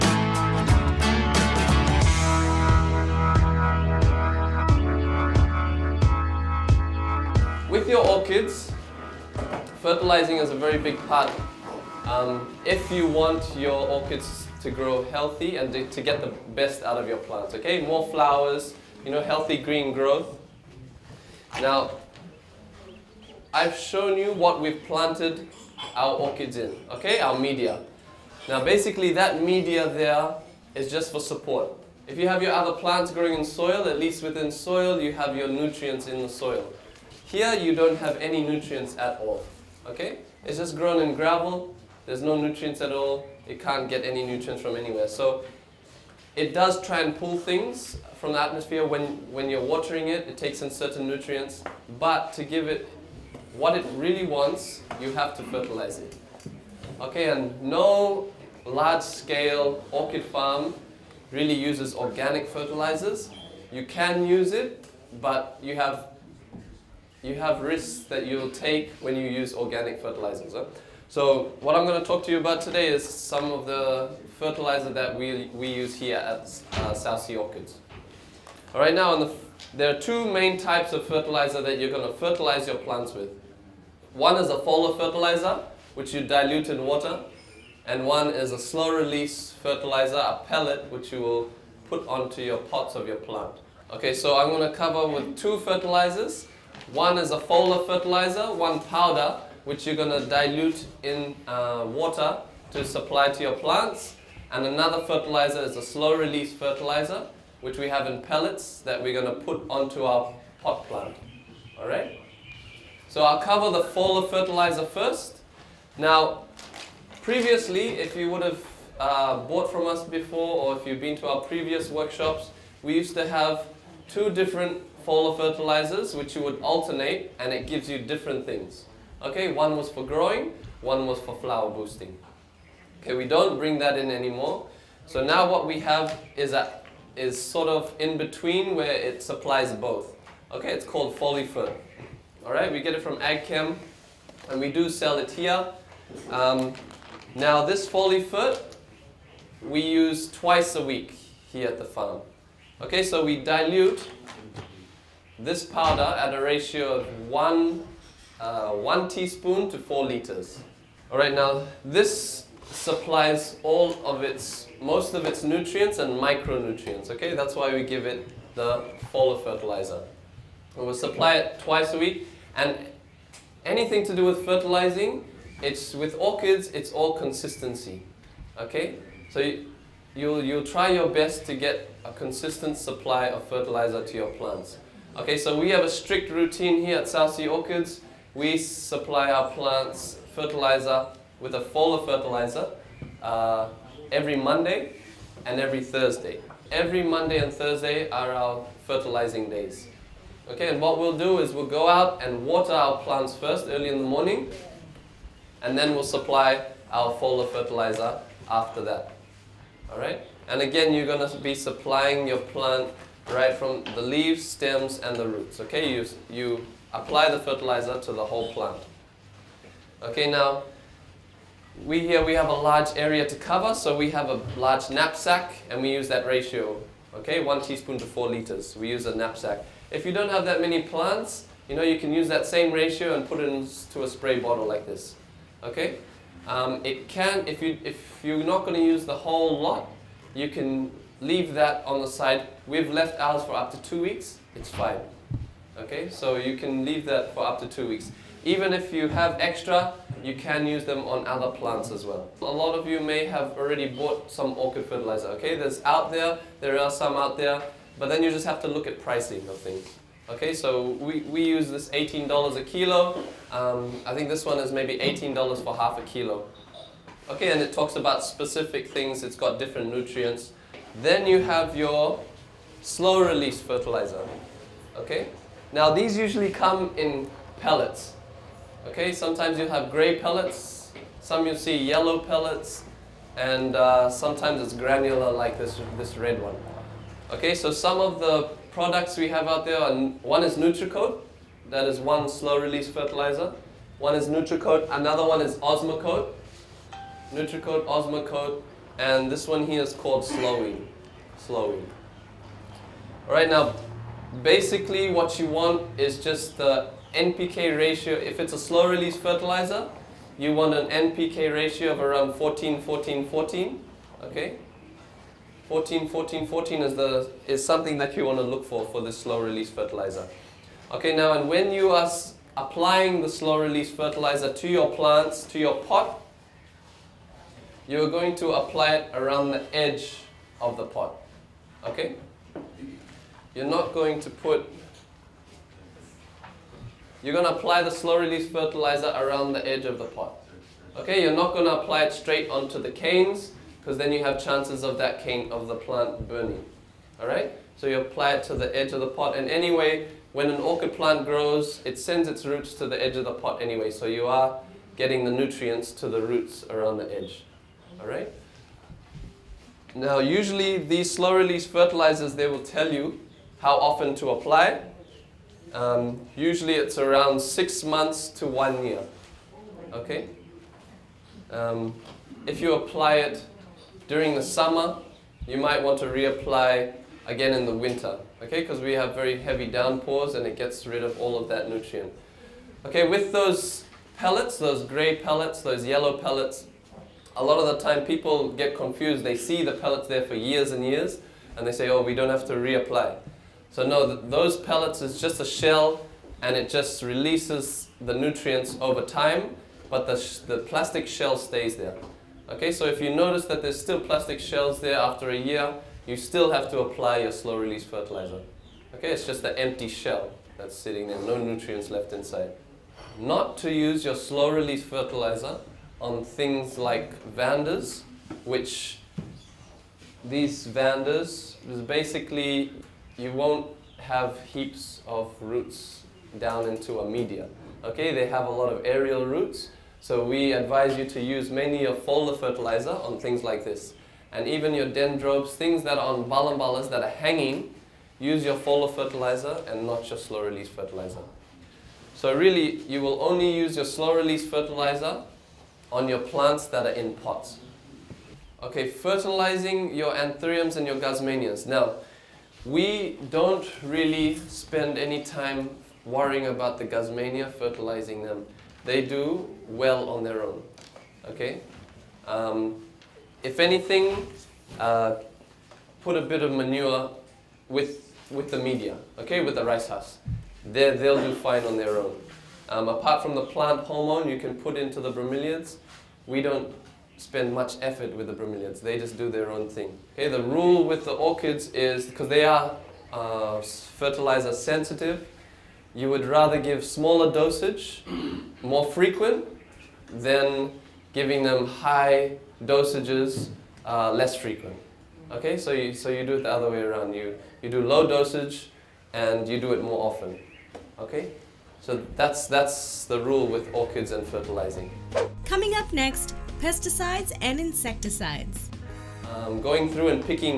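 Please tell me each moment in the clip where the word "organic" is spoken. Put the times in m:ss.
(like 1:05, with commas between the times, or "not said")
1:01, 1:09.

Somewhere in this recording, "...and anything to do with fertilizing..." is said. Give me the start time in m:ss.
2:52.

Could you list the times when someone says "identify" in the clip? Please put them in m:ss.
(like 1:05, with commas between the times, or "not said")
not said.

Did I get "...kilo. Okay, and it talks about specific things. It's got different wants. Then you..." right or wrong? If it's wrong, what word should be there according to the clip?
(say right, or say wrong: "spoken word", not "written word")
wrong: "nutrients", not "wants".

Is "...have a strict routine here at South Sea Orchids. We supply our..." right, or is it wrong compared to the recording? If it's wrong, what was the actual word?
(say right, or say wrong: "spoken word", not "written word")
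right.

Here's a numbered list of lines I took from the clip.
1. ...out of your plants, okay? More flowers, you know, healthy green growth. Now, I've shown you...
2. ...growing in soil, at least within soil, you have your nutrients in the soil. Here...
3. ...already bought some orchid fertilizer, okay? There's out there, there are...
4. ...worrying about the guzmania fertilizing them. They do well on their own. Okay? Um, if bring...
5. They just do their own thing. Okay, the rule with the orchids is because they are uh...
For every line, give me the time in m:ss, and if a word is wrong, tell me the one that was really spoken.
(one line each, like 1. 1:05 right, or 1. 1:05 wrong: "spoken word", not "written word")
1. 0:16 right
2. 0:33 right
3. 4:13 right
4. 7:36 wrong: "anything", not "bring"
5. 7:58 right.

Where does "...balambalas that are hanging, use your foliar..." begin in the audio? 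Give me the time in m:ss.
7:16.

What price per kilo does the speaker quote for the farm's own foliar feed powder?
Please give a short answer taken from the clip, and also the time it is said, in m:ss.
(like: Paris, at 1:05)
$18, at 4:21.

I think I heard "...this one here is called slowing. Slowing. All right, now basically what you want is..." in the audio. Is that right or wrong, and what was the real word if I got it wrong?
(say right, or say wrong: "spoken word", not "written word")
right.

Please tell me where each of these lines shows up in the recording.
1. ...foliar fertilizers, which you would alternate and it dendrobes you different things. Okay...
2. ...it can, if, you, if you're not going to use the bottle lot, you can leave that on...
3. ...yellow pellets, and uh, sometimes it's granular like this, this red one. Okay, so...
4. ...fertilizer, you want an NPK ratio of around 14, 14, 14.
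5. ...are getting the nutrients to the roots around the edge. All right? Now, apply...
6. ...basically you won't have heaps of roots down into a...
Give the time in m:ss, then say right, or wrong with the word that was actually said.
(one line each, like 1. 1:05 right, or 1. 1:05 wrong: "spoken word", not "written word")
1. 2:05 wrong: "gives", not "dendrobes"
2. 3:56 wrong: "whole", not "bottle"
3. 4:41 right
4. 5:09 right
5. 5:54 wrong: "usually", not "apply"
6. 7:01 right.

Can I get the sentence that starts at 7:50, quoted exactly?
they they'll do fine on their own.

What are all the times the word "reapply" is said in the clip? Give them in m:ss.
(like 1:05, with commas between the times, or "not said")
6:16, 6:32.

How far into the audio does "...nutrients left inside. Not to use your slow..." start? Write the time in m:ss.
6:51.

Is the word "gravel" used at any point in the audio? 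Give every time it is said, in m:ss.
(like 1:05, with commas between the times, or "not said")
0:41.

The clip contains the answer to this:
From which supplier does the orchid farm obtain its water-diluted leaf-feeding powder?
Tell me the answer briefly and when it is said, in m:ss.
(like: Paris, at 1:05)
AgChem, at 2:23.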